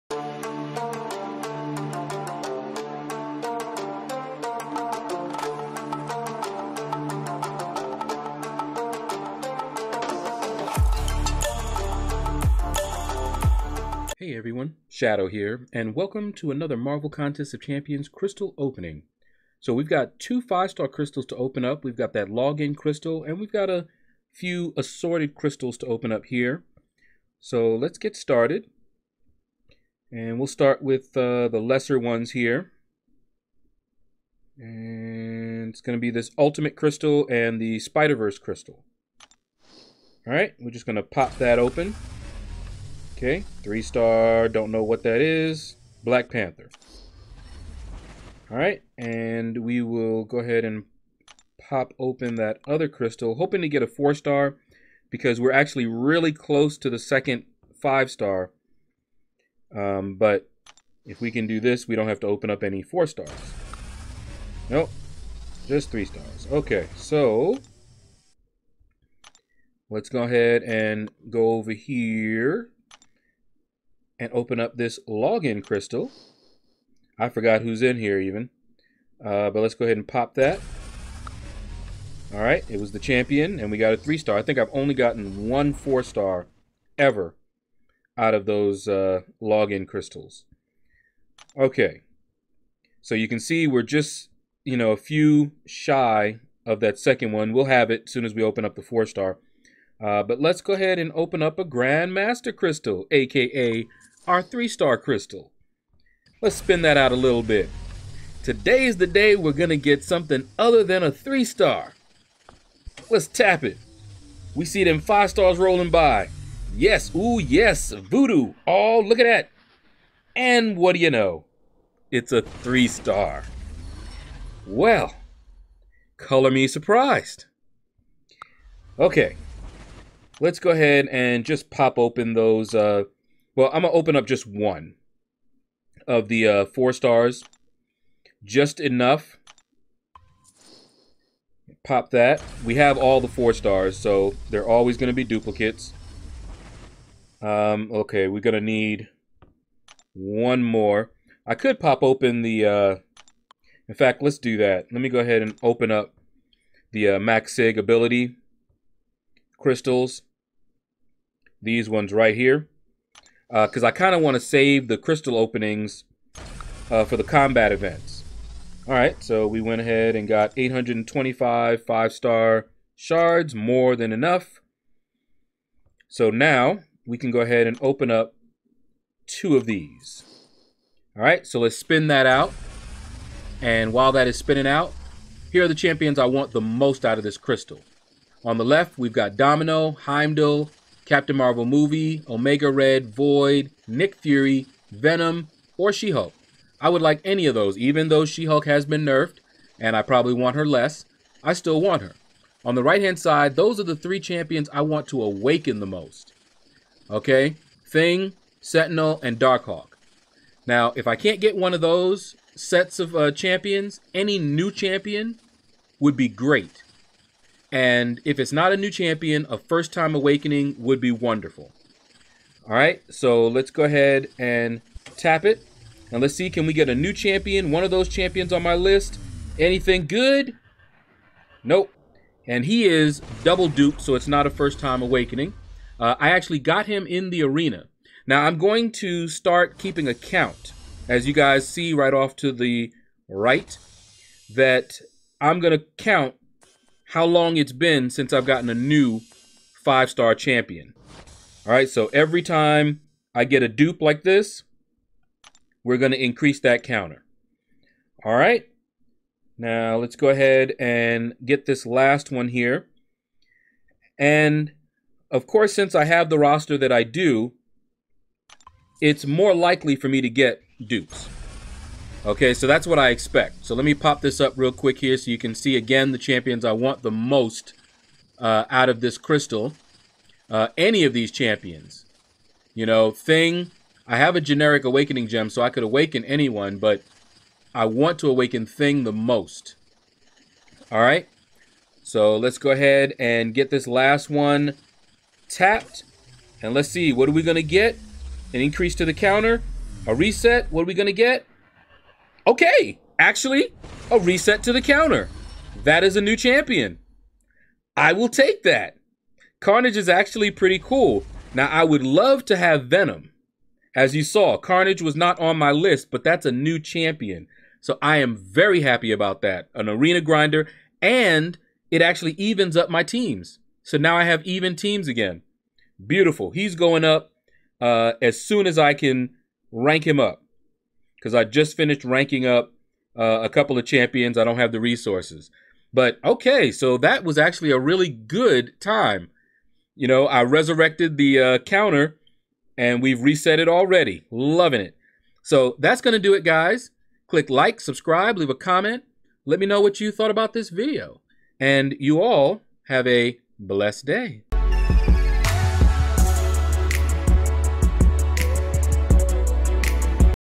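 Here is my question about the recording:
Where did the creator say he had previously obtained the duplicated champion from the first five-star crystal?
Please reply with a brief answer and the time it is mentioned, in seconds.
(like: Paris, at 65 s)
the arena, at 237 s.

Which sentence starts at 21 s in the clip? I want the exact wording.
We've got that login crystal, and we've got a few assorted crystals to open up here.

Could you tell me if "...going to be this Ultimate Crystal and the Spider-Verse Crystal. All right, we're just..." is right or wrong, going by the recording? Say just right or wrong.
right.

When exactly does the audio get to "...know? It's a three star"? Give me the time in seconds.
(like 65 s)
121 s.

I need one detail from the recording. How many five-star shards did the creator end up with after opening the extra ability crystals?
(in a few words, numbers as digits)
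825.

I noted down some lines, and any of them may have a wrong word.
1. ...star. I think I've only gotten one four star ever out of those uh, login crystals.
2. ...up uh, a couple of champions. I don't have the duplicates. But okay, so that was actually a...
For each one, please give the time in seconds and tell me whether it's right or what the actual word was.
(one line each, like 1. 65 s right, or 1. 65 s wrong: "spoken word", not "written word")
1. 84 s right
2. 332 s wrong: "resources", not "duplicates".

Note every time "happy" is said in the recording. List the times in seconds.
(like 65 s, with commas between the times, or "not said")
318 s.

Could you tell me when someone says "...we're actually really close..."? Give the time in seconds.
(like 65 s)
55 s.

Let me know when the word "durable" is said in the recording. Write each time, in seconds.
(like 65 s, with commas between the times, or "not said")
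not said.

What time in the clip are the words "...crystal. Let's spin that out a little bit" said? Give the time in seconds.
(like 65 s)
104 s.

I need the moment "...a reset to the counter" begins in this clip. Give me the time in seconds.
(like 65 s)
304 s.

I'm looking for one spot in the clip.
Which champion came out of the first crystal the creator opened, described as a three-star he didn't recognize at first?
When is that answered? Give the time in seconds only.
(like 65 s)
46 s.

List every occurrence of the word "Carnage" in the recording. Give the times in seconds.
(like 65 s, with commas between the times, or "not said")
309 s, 314 s.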